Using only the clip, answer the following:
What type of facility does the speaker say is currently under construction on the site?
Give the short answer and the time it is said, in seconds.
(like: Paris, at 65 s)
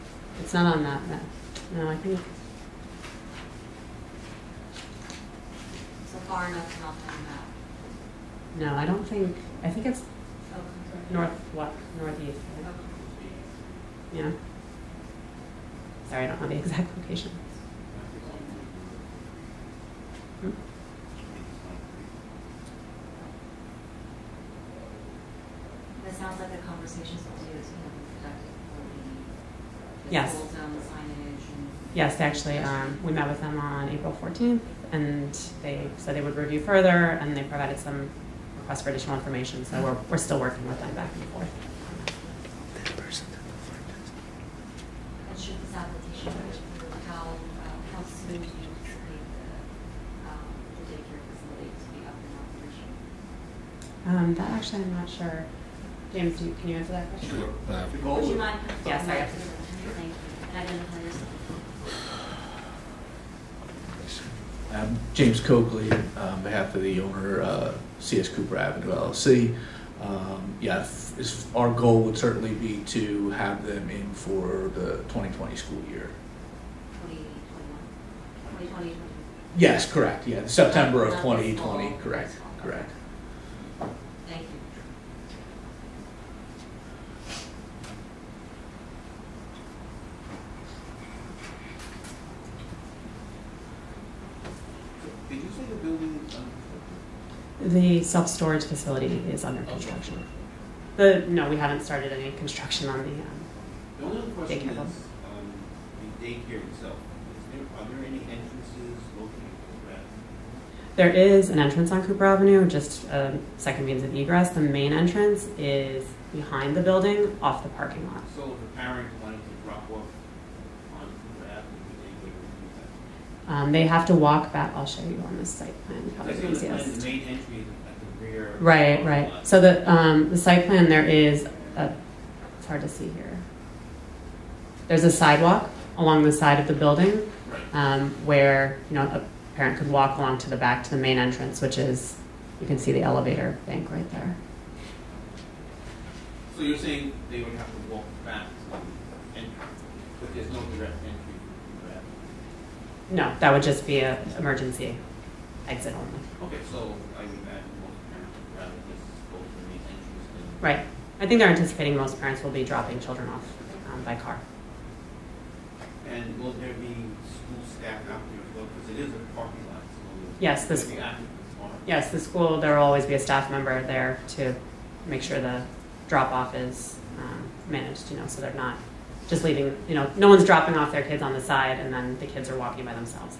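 self-storage facility, at 98 s.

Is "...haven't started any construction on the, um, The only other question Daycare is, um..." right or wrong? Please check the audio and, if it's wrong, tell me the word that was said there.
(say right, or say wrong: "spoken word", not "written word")
right.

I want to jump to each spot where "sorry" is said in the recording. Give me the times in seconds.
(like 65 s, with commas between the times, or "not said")
16 s, 59 s.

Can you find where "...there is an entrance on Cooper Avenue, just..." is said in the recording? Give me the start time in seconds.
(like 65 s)
110 s.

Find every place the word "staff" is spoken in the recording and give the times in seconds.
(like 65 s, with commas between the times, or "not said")
167 s, 173 s.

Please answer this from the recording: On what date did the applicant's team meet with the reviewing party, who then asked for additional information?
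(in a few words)
April 14th.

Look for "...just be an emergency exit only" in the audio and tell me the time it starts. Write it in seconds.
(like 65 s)
153 s.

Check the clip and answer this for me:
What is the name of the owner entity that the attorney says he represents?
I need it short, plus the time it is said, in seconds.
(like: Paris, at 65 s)
CS Cooper Avenue LLC, at 67 s.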